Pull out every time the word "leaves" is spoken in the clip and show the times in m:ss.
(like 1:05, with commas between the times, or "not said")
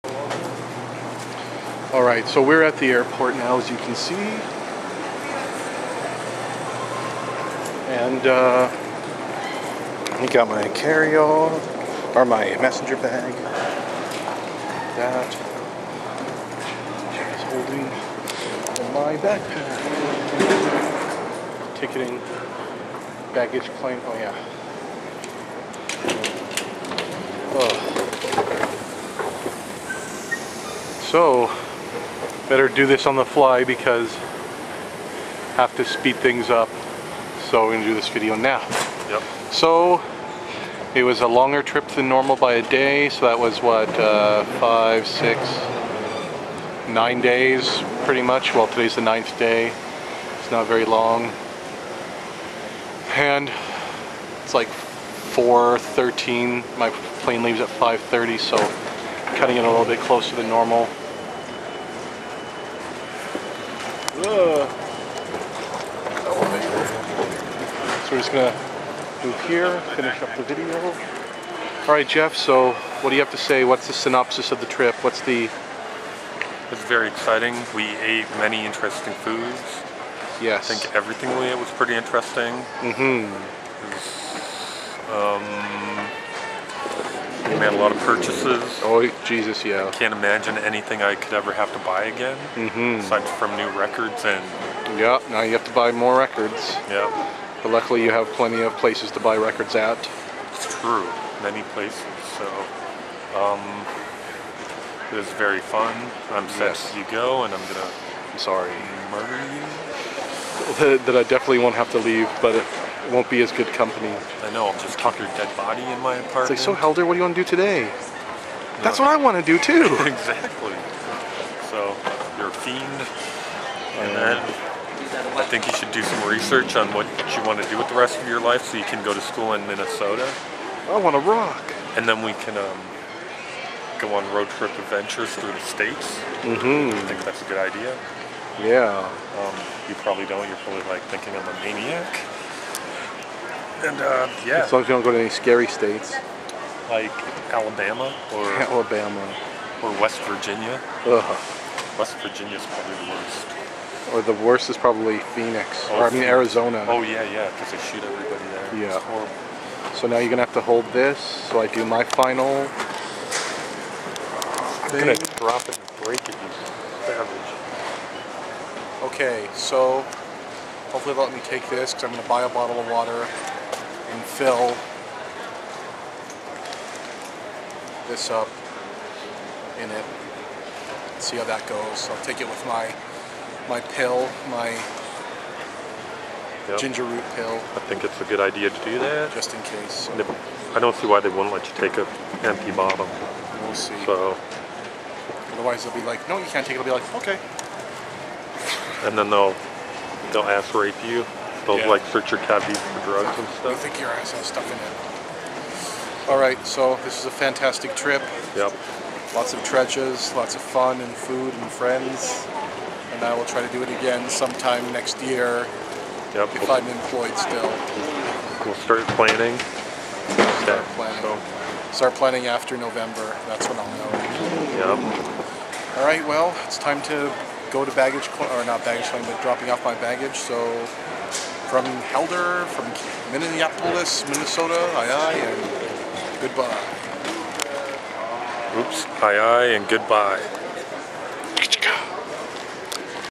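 0:57, 1:52.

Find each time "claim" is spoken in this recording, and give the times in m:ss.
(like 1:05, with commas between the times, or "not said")
0:23, 3:49.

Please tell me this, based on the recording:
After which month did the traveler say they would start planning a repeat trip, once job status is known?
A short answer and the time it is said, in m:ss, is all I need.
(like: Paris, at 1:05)
November, at 3:42.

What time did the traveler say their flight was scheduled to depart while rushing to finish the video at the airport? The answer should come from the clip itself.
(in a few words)
5:30.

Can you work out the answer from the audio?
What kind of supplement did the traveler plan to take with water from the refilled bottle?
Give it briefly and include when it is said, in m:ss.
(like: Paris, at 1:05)
ginger root pill, at 3:06.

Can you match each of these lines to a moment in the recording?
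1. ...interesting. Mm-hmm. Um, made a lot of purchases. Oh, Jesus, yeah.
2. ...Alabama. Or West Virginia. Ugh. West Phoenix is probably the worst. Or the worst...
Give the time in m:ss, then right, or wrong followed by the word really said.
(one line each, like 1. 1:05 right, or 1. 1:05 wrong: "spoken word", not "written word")
1. 1:21 right
2. 2:28 wrong: "Virginia", not "Phoenix".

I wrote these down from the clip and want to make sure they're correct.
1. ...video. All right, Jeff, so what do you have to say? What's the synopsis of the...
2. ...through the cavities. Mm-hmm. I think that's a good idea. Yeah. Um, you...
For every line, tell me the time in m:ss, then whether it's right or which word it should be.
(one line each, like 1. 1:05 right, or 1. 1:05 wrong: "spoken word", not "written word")
1. 1:10 right
2. 2:15 wrong: "states", not "cavities".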